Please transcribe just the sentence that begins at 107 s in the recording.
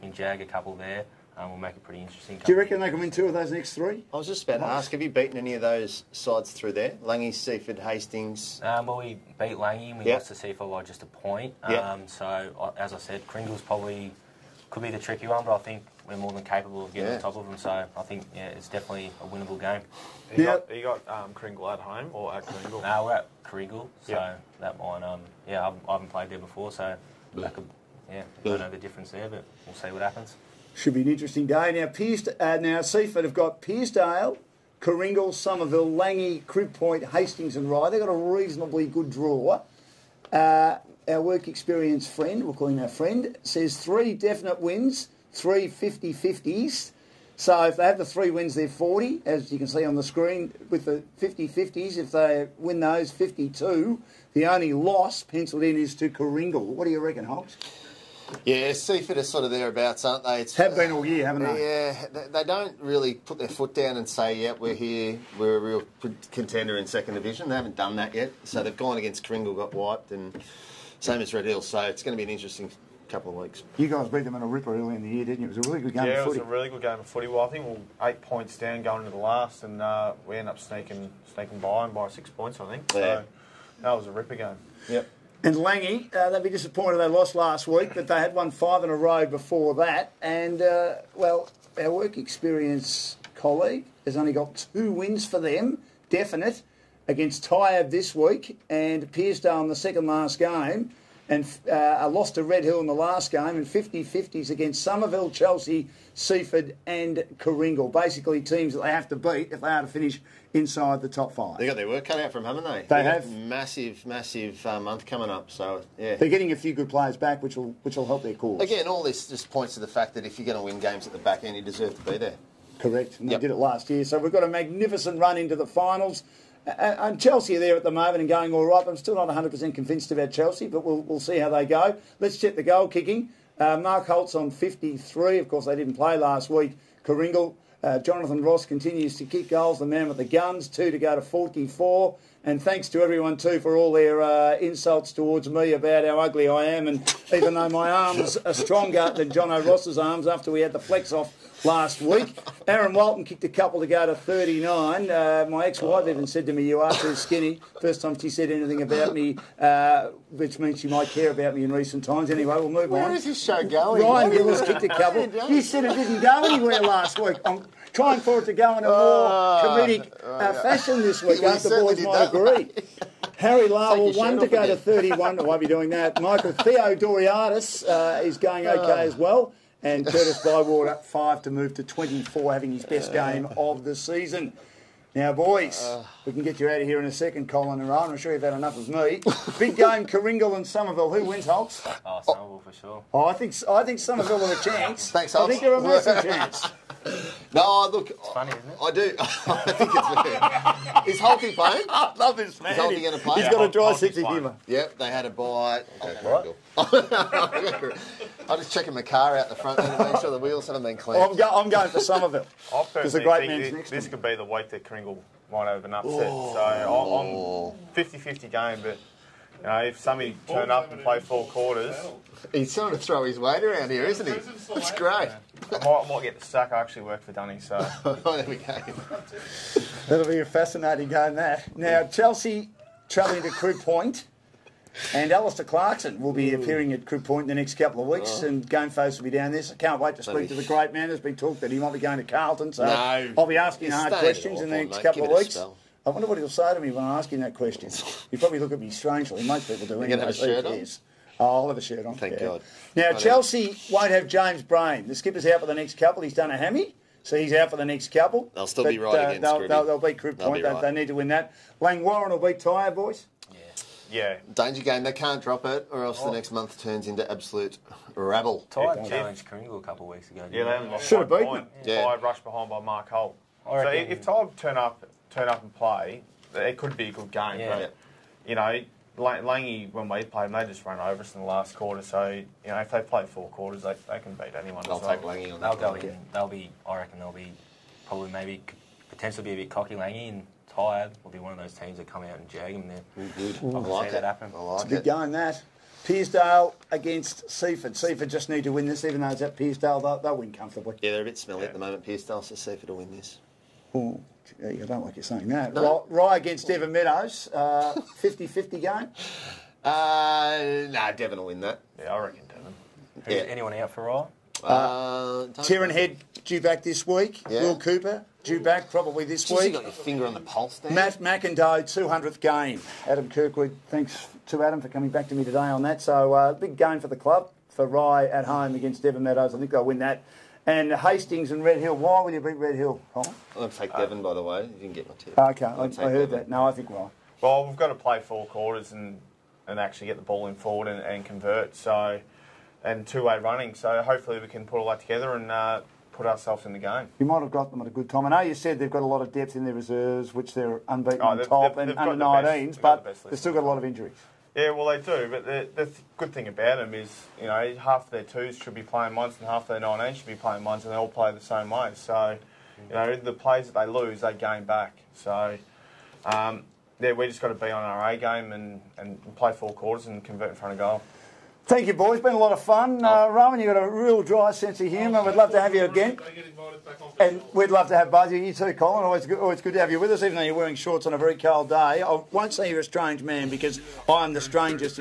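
Basically, teams that they have to beat if they are to finish inside the top five.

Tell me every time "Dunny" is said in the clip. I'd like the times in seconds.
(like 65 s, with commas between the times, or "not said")
227 s.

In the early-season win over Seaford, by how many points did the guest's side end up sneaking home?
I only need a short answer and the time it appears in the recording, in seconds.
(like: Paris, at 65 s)
6, at 82 s.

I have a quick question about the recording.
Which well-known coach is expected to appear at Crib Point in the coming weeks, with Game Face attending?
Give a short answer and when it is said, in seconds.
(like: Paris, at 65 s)
Alastair Clarkson, at 235 s.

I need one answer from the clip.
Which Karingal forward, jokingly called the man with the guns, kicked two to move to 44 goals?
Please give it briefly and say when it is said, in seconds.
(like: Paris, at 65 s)
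Jonathan Ross, at 137 s.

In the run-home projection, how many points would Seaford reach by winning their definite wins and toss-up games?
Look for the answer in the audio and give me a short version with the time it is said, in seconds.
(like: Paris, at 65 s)
52, at 53 s.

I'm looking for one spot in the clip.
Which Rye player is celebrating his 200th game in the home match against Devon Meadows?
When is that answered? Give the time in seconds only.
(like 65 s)
320 s.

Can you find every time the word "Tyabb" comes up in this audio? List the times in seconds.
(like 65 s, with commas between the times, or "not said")
97 s, 262 s.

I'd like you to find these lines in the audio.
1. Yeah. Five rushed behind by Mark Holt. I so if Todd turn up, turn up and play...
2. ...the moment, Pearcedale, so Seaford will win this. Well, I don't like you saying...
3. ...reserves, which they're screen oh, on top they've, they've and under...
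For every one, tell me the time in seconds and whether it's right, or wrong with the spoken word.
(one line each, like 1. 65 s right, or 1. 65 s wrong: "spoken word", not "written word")
1. 271 s right
2. 301 s right
3. 349 s wrong: "unbeaten", not "screen".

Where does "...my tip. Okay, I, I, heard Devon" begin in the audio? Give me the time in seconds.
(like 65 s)
335 s.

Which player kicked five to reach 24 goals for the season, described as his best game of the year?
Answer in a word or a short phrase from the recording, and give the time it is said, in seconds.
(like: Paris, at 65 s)
Curtis Bywater, at 180 s.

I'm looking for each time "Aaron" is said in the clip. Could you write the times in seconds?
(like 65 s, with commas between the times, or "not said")
152 s.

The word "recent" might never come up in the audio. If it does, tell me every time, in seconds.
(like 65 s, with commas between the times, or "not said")
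161 s.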